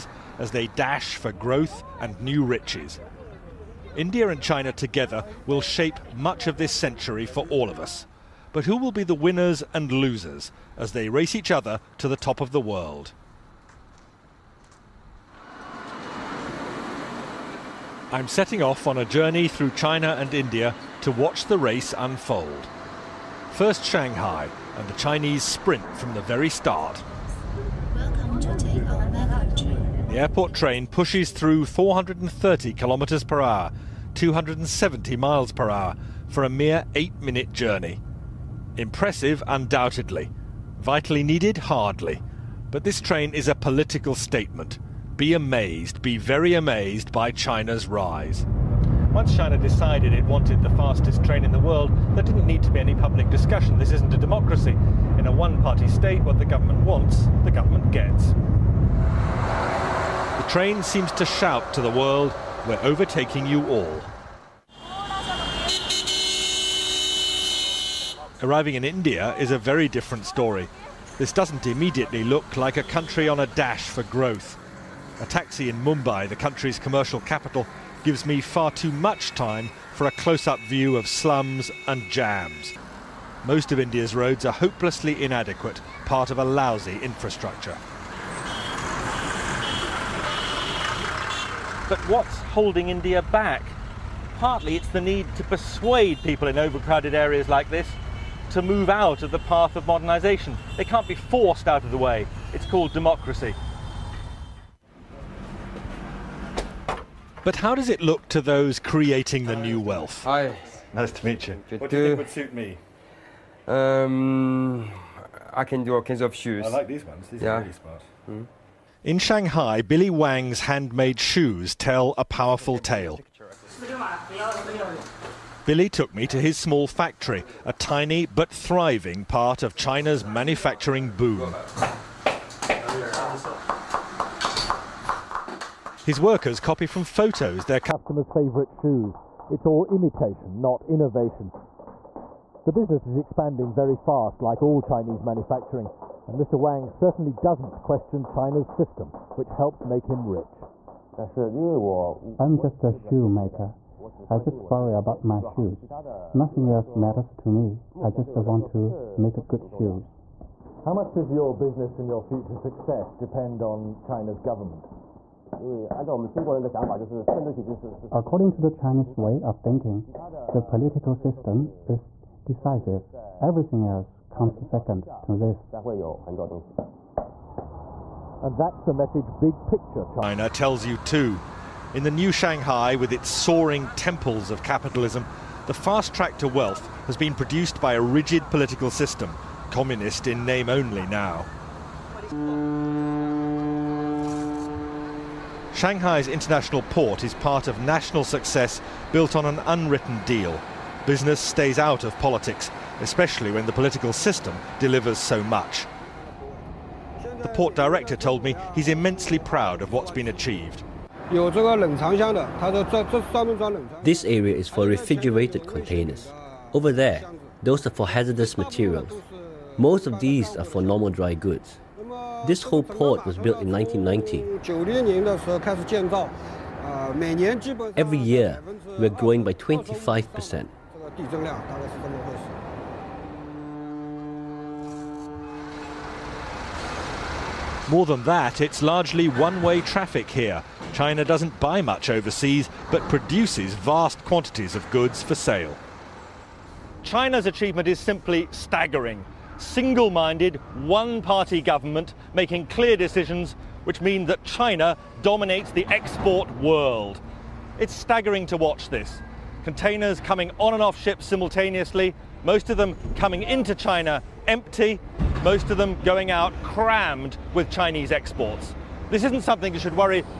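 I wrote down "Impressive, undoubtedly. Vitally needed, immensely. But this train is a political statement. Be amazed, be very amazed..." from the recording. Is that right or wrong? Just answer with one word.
wrong.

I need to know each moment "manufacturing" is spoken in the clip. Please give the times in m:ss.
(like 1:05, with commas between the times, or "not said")
2:10, 2:25.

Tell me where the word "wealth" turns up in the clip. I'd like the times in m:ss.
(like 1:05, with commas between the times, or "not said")
1:49, 3:06.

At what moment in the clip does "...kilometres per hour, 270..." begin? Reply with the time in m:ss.
0:32.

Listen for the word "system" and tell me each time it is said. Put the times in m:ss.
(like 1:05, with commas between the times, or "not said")
2:28, 2:51, 3:08, 3:24.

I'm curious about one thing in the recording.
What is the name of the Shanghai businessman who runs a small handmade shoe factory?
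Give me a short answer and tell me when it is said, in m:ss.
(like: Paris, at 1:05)
Billy Wang, at 1:59.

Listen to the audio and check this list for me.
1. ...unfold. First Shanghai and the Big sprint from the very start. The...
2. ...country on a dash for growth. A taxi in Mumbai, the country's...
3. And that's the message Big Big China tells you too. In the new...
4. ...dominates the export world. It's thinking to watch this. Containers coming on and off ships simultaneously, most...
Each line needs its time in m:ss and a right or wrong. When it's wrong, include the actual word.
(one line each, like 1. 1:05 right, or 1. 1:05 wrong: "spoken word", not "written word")
1. 0:21 wrong: "Chinese", not "Big"
2. 1:12 right
3. 2:58 wrong: "Picture", not "Big"
4. 4:15 wrong: "staggering", not "thinking".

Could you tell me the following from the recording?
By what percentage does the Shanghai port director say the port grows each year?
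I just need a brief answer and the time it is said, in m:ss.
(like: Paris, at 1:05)
25%, at 3:49.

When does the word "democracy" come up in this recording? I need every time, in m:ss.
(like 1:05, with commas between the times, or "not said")
0:54, 1:42.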